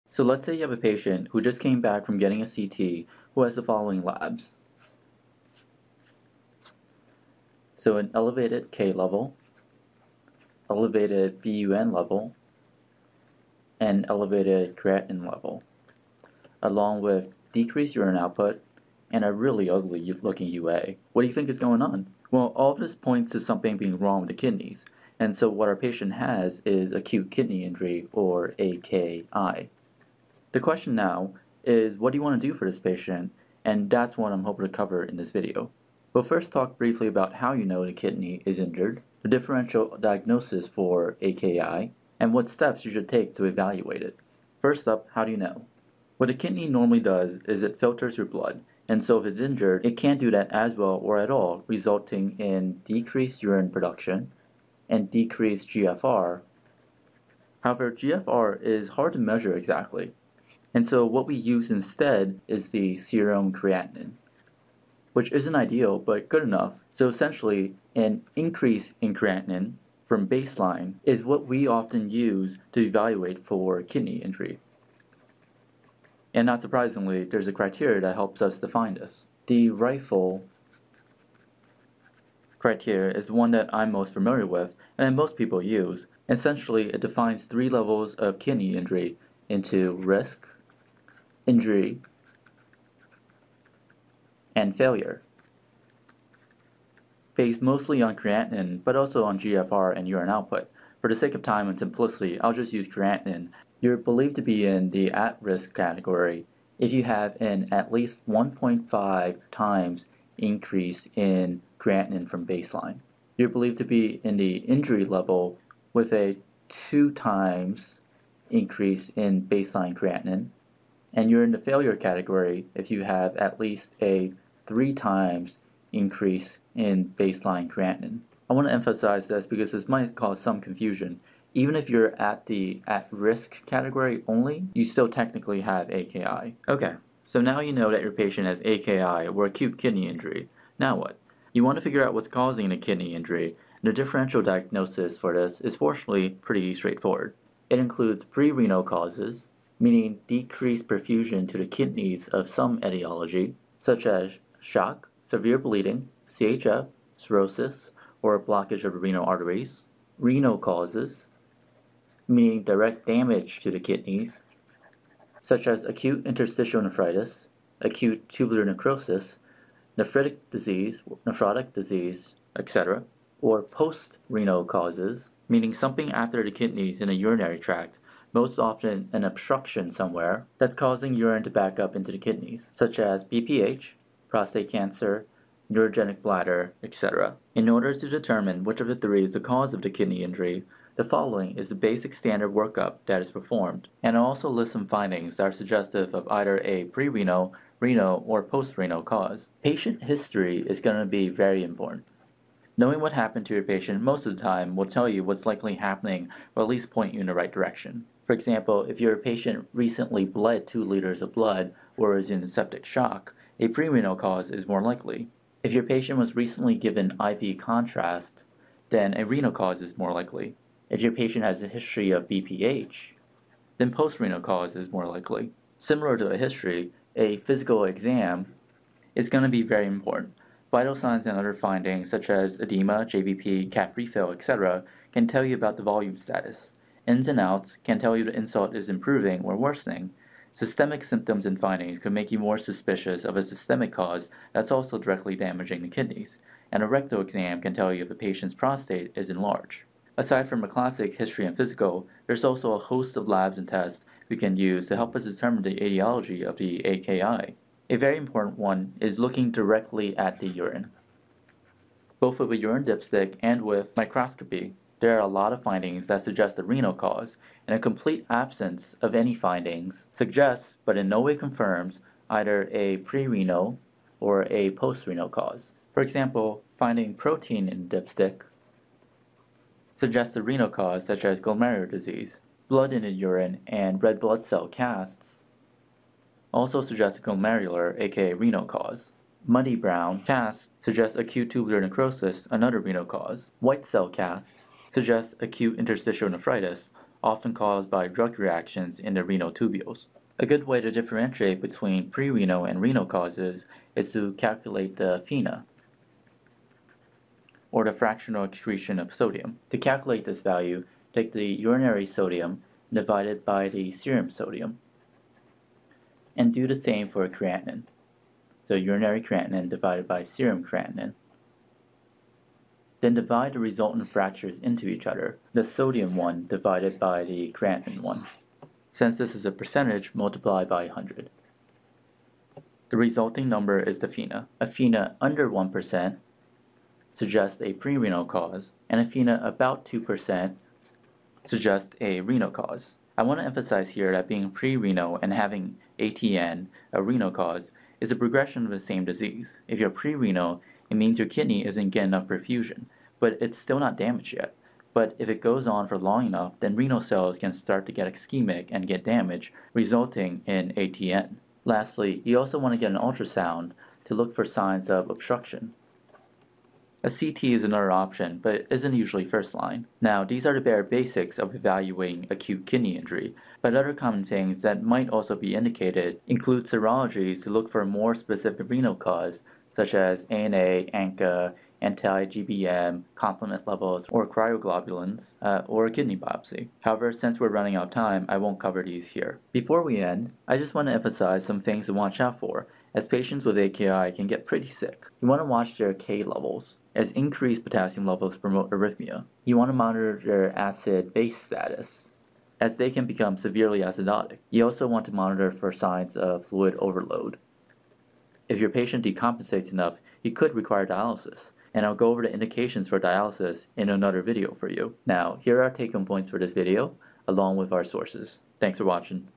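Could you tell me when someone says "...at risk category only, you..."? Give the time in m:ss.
2:12.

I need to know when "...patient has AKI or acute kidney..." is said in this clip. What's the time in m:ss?
2:18.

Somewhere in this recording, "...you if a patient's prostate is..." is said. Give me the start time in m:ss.
4:07.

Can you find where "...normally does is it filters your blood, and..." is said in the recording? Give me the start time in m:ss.
0:46.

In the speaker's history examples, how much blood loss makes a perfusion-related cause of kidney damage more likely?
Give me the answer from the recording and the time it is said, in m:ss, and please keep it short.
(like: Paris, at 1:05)
2 liters, at 3:30.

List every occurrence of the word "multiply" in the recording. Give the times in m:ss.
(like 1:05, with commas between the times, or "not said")
5:30.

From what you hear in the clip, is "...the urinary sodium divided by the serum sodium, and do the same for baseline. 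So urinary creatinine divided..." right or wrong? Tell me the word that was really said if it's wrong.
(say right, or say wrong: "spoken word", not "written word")
wrong: "creatinine", not "baseline".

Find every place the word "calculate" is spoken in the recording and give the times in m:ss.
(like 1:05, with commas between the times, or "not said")
5:04, 5:09.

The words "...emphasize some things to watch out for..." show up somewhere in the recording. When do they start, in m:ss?
6:30.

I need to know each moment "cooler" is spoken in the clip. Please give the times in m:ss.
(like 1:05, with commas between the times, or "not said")
not said.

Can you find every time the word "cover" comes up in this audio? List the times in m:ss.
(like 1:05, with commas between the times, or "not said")
0:34, 6:28.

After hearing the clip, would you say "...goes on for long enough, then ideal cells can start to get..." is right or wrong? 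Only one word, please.
wrong.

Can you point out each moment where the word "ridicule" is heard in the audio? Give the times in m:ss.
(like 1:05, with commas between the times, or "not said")
not said.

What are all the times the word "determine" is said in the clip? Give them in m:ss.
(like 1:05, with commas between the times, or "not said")
3:08, 4:15.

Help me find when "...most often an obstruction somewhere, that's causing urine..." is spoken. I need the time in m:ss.
2:58.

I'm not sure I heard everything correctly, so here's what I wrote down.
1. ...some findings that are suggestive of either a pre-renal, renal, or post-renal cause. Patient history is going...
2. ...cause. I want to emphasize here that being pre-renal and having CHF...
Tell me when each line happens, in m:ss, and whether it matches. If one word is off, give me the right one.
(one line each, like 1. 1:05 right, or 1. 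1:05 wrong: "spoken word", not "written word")
1. 3:14 right
2. 5:42 wrong: "ATN", not "CHF".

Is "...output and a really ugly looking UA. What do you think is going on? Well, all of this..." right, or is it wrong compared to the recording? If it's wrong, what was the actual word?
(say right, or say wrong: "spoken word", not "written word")
right.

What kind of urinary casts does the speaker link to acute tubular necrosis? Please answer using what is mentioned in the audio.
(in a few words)
Muddy brown casts.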